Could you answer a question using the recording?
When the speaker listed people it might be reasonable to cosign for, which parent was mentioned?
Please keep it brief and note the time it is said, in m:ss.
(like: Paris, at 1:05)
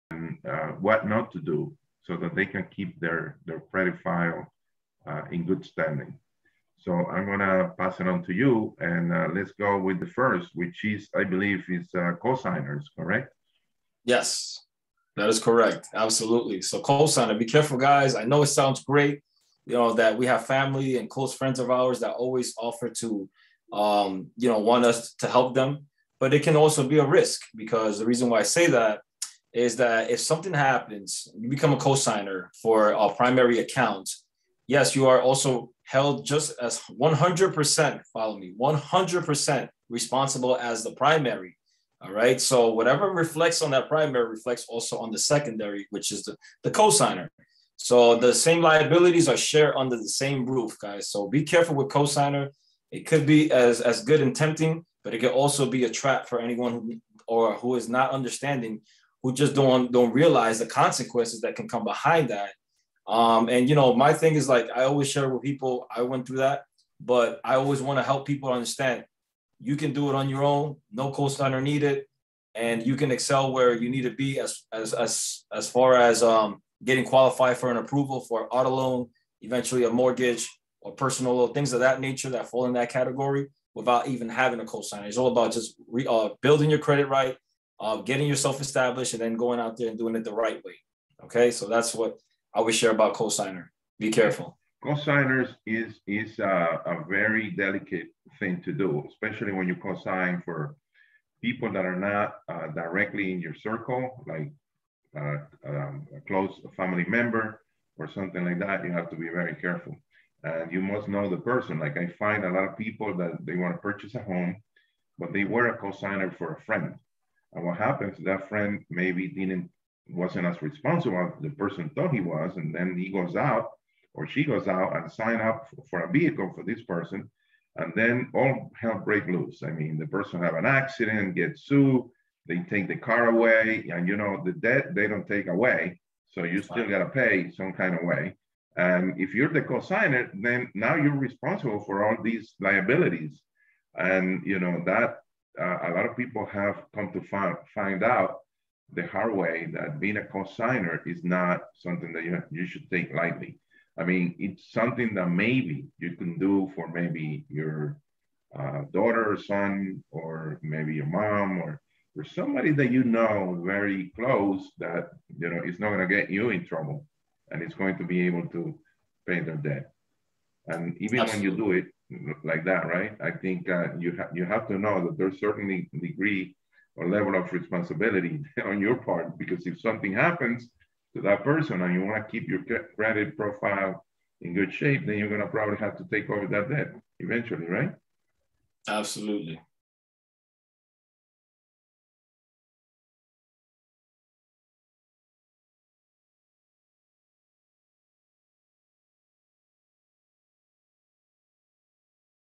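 mom, at 2:40.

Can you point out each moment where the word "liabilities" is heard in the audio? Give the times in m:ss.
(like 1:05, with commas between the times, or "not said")
0:48, 2:22.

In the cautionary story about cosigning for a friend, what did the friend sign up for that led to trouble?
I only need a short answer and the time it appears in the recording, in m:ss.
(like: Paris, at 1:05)
a vehicle, at 2:06.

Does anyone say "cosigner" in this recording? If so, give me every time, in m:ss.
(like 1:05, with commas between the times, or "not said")
0:12, 0:16, 0:46, 0:51.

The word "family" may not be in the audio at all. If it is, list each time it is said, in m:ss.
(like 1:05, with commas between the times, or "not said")
0:20, 1:46.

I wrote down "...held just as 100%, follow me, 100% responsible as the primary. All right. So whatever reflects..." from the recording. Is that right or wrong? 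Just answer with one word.
right.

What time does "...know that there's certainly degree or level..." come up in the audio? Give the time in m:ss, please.
2:54.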